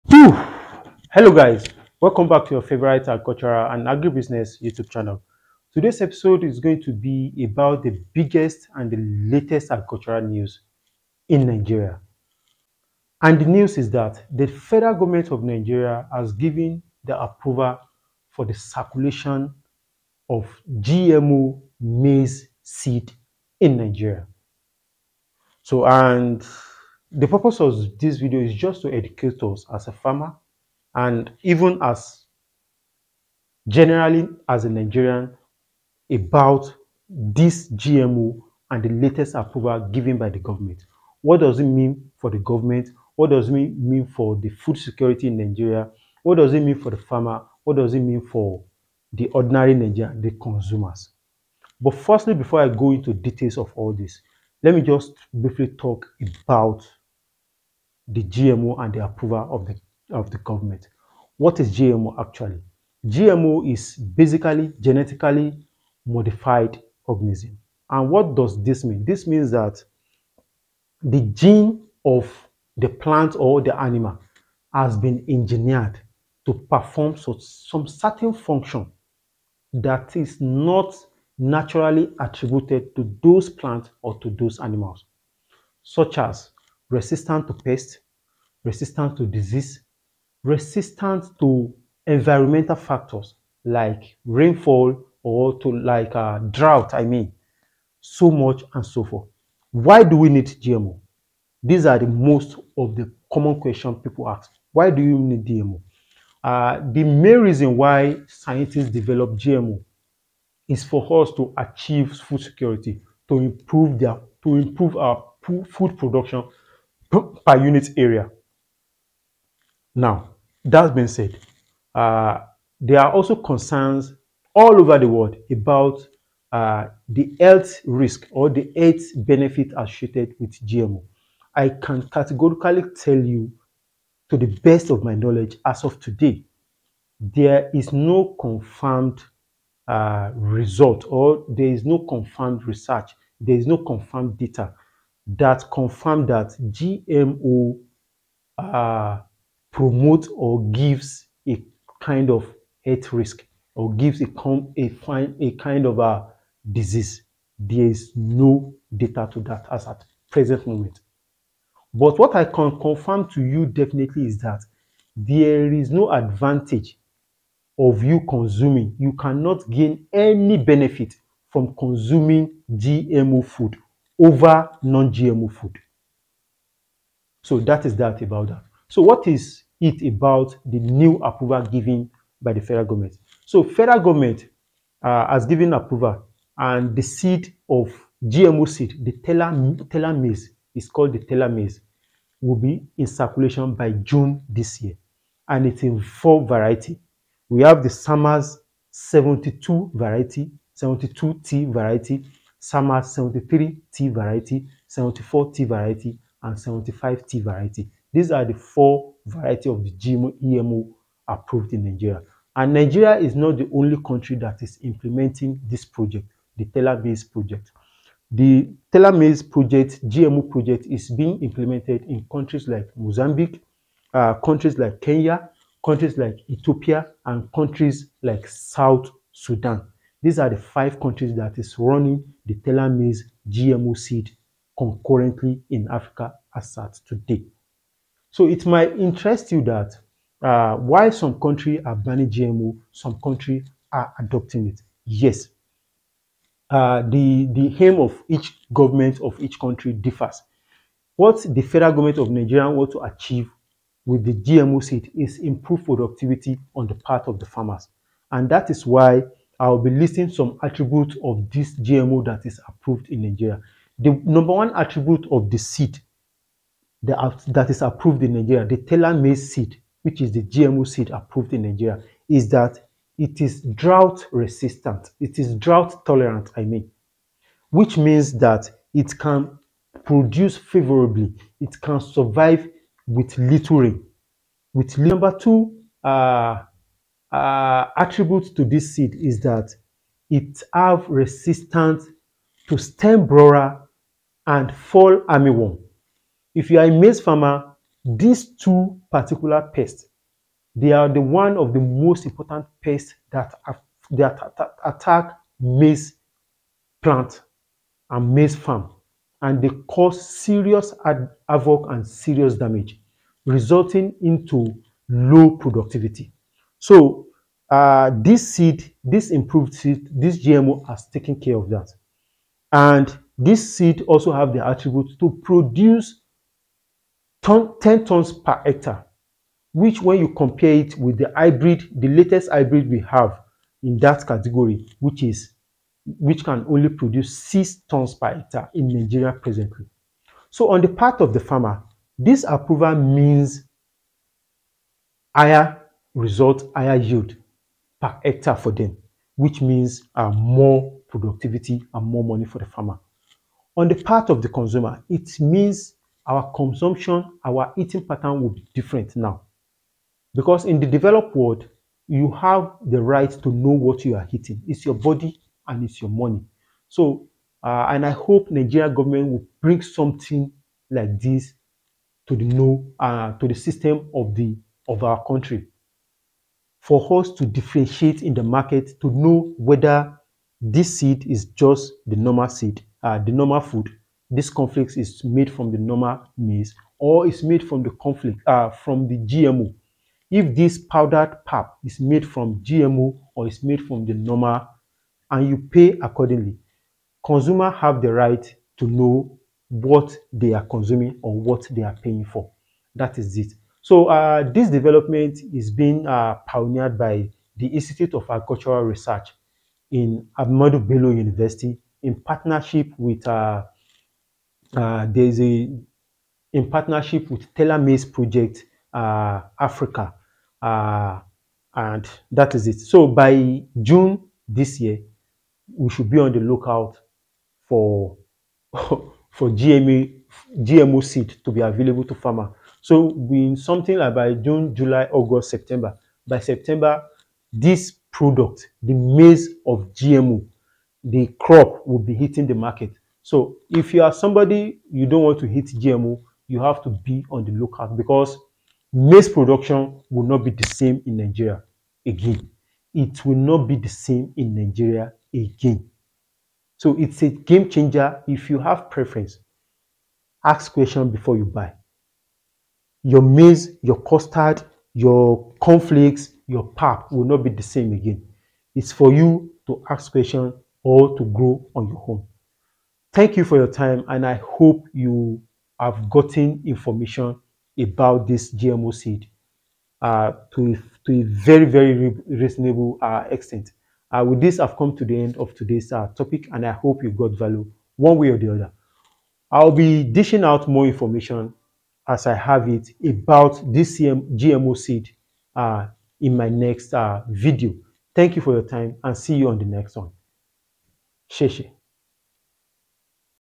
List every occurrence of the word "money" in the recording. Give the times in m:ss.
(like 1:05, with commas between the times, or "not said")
5:52, 6:06.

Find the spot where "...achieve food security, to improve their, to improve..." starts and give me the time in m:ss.
1:51.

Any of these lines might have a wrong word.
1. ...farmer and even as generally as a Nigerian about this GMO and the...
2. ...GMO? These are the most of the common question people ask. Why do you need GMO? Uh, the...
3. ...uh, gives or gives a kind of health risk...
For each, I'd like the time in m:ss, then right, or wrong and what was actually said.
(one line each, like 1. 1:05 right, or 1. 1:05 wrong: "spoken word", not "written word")
1. 0:29 right
2. 1:40 right
3. 2:28 wrong: "promotes", not "gives".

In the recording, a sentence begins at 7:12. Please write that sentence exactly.
So in something like by June, July, August, September.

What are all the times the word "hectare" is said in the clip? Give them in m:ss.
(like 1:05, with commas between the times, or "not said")
5:28, 5:38, 5:48.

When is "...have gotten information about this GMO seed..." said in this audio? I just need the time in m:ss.
7:55.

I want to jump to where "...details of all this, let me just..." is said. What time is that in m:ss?
0:53.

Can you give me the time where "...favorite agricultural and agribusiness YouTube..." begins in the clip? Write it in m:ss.
0:02.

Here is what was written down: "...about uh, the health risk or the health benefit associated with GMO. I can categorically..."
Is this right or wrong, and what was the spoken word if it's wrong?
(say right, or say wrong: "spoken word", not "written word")
right.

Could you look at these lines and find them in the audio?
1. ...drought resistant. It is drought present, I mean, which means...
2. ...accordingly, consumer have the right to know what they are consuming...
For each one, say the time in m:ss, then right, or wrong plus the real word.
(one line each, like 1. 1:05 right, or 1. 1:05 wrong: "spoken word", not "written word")
1. 4:33 wrong: "tolerant", not "present"
2. 6:36 right.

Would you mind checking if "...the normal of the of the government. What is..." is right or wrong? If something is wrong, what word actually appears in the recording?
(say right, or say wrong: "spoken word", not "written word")
wrong: "approval", not "normal".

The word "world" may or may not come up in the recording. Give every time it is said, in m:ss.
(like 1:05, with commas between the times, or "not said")
2:05, 6:01.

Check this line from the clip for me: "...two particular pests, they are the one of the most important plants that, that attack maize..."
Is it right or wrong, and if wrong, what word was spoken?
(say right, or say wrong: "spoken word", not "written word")
wrong: "pests", not "plants".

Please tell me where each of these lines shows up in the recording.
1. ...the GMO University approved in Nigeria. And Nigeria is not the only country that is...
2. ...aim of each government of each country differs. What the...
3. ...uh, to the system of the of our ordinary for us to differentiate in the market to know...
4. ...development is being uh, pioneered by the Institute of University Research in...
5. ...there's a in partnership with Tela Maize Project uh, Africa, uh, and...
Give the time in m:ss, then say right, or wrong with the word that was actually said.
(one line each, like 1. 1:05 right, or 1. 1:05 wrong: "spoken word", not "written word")
1. 3:29 wrong: "EMO", not "University"
2. 4:07 right
3. 6:12 wrong: "country", not "ordinary"
4. 6:44 wrong: "Agricultural", not "University"
5. 6:55 right.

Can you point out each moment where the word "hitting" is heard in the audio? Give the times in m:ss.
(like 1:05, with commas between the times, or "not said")
7:22.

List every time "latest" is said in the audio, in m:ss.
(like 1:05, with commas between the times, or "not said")
0:08, 0:38, 5:32.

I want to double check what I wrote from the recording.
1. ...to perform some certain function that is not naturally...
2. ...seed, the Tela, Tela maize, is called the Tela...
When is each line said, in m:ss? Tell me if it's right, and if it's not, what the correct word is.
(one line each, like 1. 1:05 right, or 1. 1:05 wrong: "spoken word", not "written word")
1. 1:16 right
2. 3:08 right.